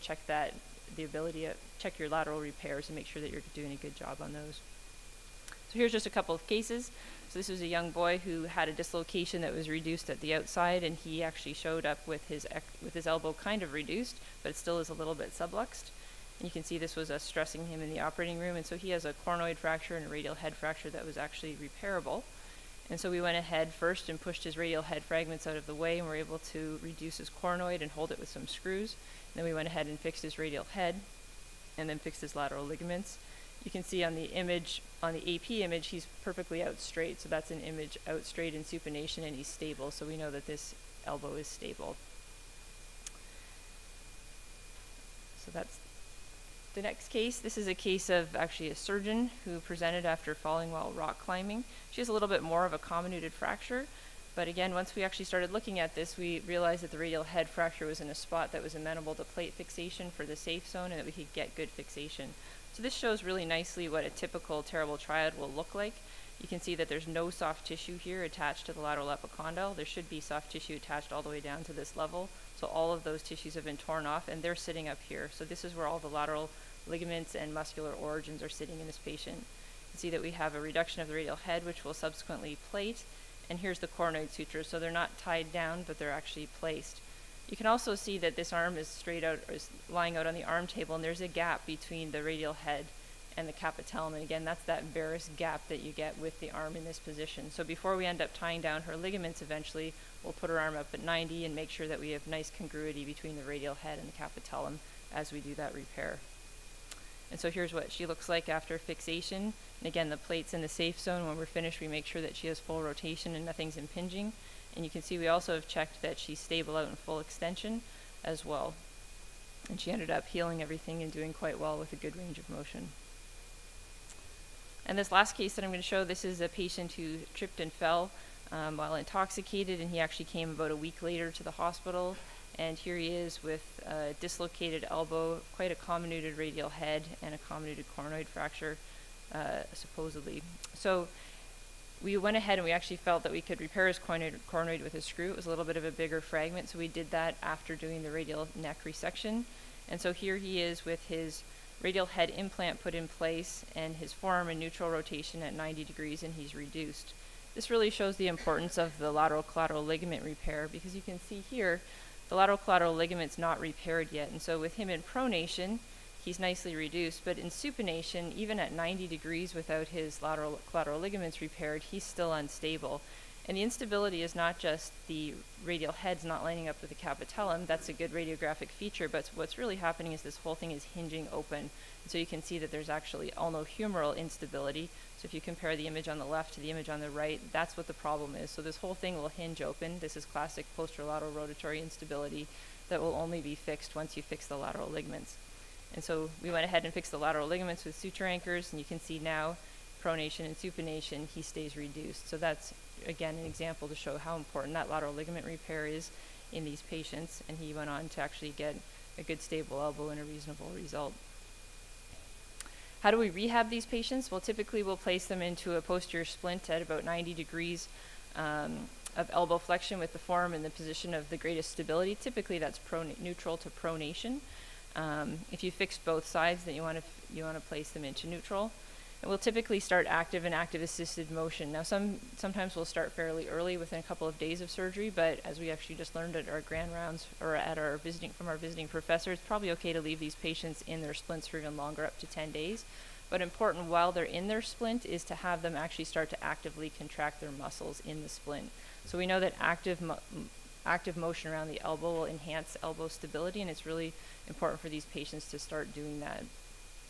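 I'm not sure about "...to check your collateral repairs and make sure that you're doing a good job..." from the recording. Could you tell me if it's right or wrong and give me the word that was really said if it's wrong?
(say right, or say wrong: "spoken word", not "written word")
wrong: "lateral", not "collateral".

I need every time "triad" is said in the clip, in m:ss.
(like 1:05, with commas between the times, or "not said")
1:04.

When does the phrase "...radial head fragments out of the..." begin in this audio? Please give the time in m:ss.
0:24.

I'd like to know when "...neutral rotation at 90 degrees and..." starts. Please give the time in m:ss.
2:34.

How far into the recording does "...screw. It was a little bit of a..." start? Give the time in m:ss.
2:25.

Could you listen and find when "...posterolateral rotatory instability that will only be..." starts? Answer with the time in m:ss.
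3:10.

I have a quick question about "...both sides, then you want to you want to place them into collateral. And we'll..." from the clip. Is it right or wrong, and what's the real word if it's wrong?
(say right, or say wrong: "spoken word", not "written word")
wrong: "neutral", not "collateral".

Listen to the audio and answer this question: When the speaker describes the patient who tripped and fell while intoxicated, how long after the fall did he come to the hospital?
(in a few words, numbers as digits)
about a week.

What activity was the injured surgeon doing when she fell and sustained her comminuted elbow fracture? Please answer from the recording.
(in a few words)
rock climbing.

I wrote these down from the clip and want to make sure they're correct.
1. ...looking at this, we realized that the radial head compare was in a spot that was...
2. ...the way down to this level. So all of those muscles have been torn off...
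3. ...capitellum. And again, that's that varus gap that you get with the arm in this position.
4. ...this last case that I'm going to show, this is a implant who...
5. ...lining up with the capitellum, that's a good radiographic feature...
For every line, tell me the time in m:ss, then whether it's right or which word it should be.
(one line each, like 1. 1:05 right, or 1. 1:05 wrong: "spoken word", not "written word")
1. 0:55 wrong: "fracture", not "compare"
2. 1:11 wrong: "tissues", not "muscles"
3. 1:33 right
4. 2:04 wrong: "patient", not "implant"
5. 2:56 right.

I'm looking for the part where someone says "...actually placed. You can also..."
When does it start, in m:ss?
1:26.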